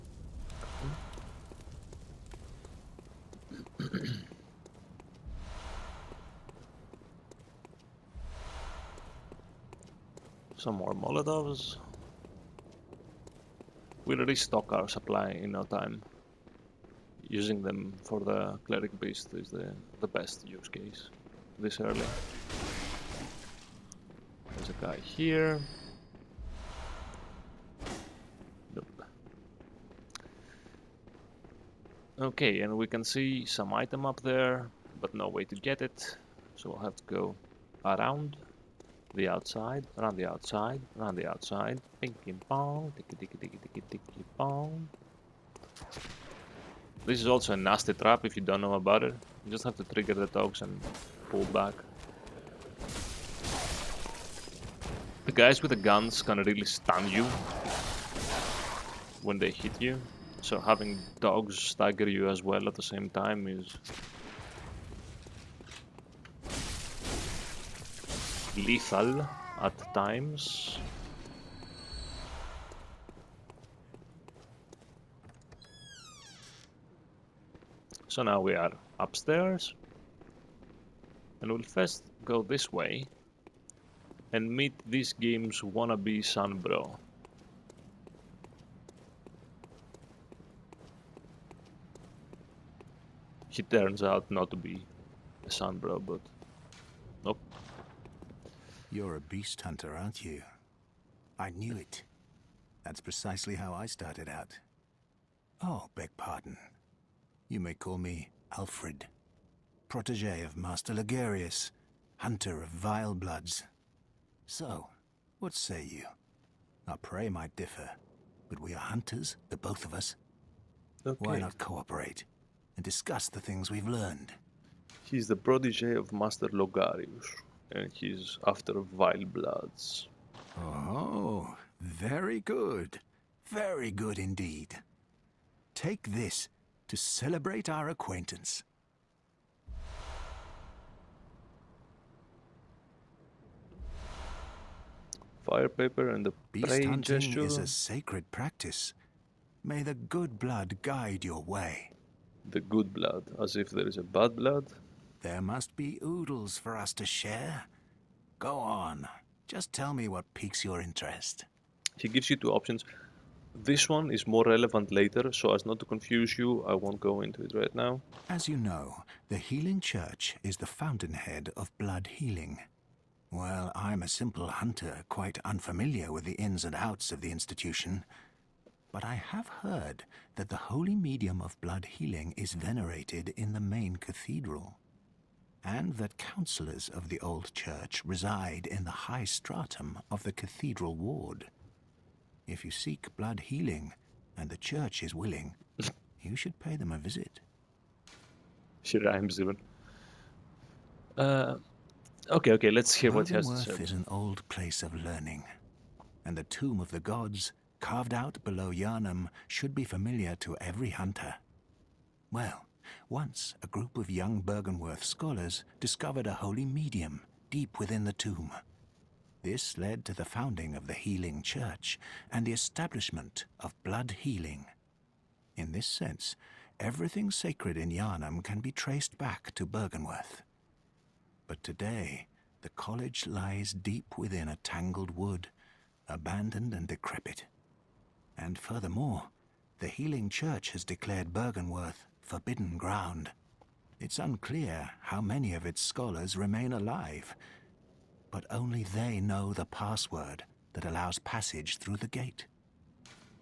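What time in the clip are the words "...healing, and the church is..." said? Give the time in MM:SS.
03:13.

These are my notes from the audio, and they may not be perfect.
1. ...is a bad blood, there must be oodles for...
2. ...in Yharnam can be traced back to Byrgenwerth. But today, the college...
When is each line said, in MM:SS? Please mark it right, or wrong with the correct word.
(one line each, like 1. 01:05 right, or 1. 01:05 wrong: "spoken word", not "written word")
1. 02:33 right
2. 03:47 right.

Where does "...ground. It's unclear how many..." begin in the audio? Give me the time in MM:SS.
04:02.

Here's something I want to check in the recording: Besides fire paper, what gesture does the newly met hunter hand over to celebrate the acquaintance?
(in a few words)
Beast hunting gesture.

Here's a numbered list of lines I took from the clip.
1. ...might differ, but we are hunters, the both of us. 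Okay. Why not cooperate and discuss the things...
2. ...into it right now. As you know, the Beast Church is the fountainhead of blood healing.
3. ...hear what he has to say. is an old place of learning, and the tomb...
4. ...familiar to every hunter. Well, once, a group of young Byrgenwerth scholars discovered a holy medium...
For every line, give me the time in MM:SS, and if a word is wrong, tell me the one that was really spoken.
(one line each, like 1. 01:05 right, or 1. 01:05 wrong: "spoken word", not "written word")
1. 01:57 right
2. 02:47 wrong: "Healing", not "Beast"
3. 03:22 right
4. 03:29 right.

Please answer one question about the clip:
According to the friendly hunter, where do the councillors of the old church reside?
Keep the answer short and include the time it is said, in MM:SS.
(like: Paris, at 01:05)
High stratum of the cathedral ward, at 03:09.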